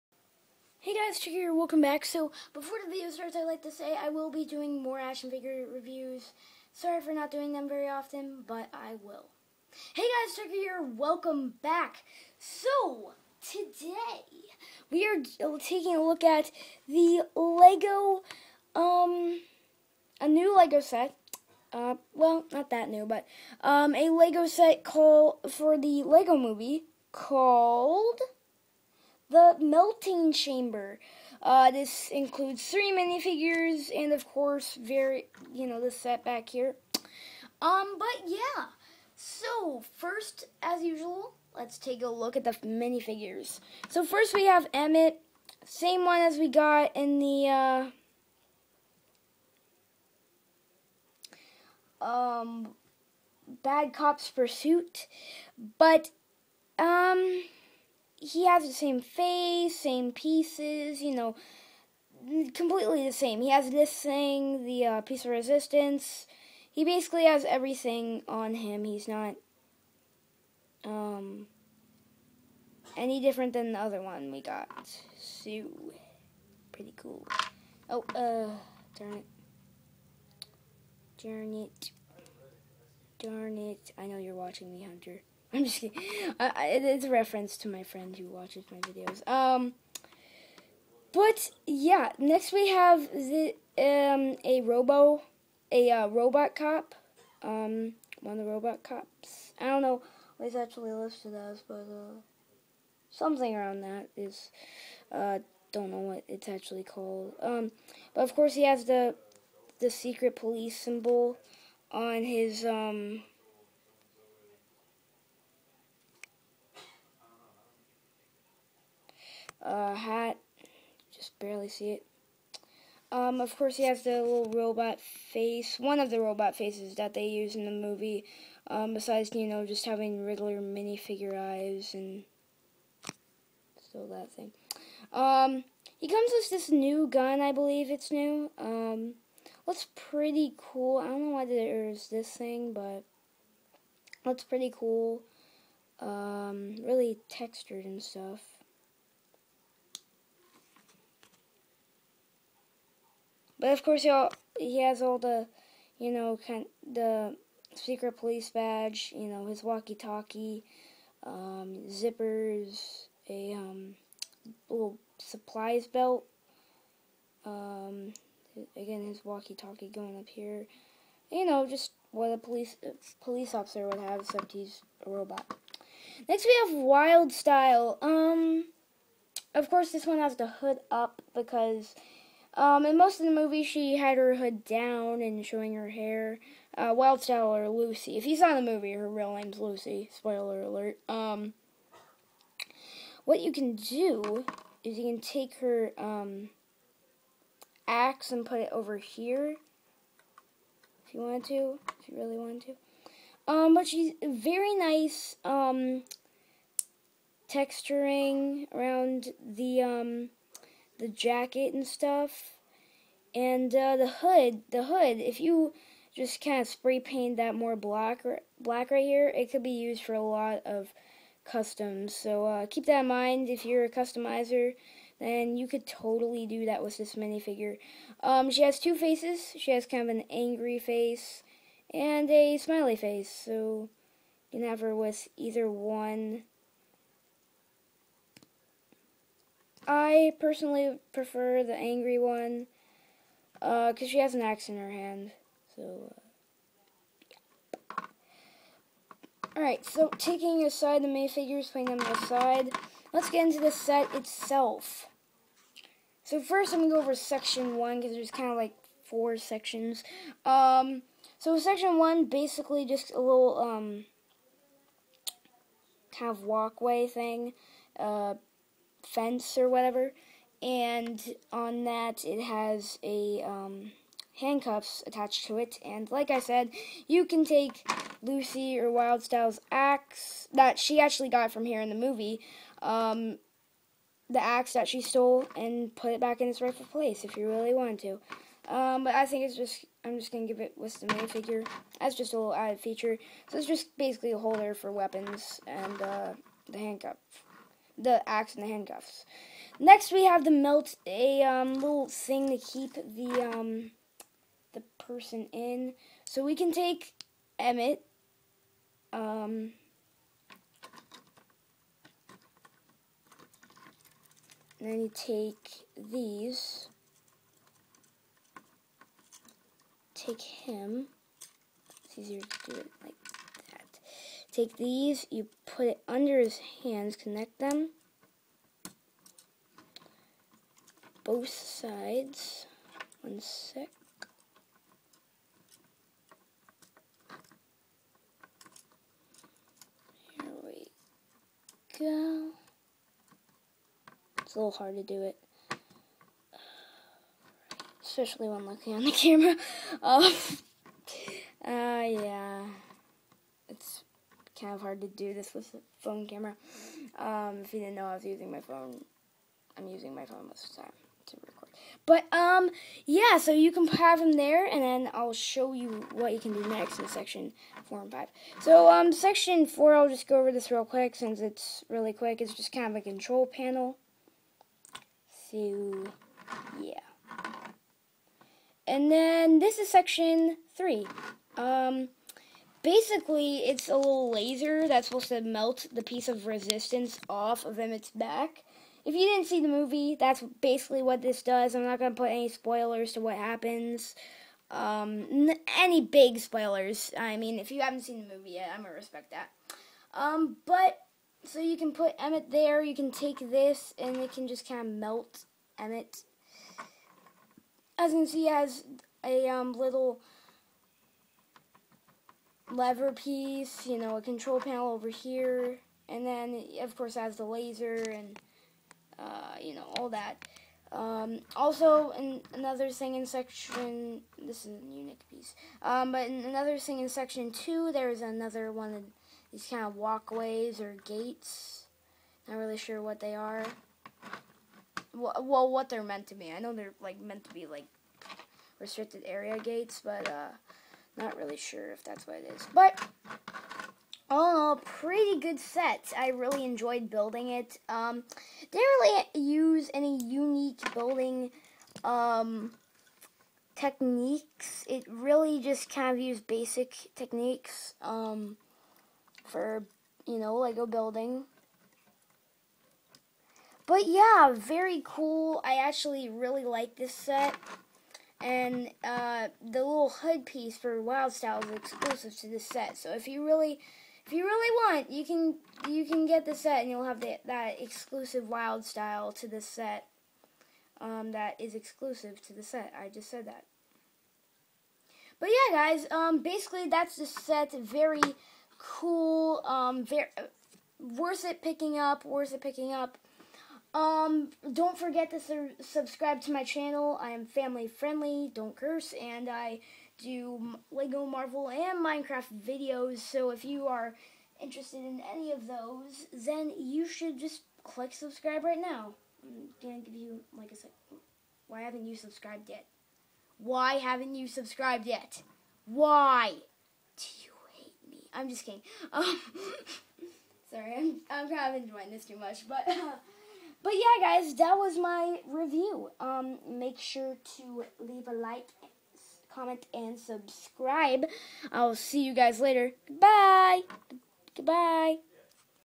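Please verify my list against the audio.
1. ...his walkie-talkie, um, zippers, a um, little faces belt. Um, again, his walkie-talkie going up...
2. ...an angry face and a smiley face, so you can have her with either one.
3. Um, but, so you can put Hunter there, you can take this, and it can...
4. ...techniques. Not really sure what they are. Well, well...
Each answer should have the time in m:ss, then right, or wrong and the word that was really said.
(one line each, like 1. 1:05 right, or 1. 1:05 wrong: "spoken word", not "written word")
1. 2:39 wrong: "supplies", not "faces"
2. 3:50 right
3. 6:40 wrong: "Emmet", not "Hunter"
4. 7:11 wrong: "gates", not "techniques".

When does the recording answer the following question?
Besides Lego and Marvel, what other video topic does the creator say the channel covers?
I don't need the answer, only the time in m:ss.
8:22.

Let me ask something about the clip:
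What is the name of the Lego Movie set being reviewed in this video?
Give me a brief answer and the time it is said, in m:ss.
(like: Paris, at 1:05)
The Melting Chamber, at 0:29.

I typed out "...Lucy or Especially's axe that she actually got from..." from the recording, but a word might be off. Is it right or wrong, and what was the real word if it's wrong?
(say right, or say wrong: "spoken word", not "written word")
wrong: "Wyldstyle", not "Especially".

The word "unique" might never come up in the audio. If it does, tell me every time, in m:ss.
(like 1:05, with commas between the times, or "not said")
7:04, 7:30.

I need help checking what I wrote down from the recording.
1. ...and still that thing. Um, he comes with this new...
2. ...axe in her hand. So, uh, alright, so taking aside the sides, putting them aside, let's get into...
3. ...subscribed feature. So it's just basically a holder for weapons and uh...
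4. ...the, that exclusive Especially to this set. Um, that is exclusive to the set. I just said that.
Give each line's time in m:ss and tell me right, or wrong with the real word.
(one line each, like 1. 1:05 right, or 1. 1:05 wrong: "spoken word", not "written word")
1. 2:11 right
2. 4:04 wrong: "minifigures", not "sides"
3. 4:52 wrong: "added", not "subscribed"
4. 7:57 wrong: "Wyldstyle", not "Especially".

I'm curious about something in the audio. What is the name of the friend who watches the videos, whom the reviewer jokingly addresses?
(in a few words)
Hunter.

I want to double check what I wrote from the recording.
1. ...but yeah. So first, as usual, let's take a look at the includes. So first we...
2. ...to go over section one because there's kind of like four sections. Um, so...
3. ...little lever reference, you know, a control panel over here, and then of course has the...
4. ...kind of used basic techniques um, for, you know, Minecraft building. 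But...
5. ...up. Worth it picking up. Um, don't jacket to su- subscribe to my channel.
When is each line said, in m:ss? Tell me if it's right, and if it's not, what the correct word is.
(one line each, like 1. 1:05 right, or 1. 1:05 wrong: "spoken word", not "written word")
1. 0:37 wrong: "minifigures", not "includes"
2. 4:16 right
3. 6:49 wrong: "piece", not "reference"
4. 7:35 wrong: "Lego", not "Minecraft"
5. 8:11 wrong: "forget", not "jacket".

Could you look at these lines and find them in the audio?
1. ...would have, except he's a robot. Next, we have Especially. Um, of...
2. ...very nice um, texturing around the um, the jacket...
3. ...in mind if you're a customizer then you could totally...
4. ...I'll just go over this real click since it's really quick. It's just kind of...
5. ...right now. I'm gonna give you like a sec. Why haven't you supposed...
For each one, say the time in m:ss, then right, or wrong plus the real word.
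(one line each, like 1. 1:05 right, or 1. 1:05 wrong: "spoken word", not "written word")
1. 2:53 wrong: "Wyldstyle", not "Especially"
2. 3:24 right
3. 3:43 right
4. 6:09 wrong: "quick", not "click"
5. 8:28 wrong: "subscribed", not "supposed".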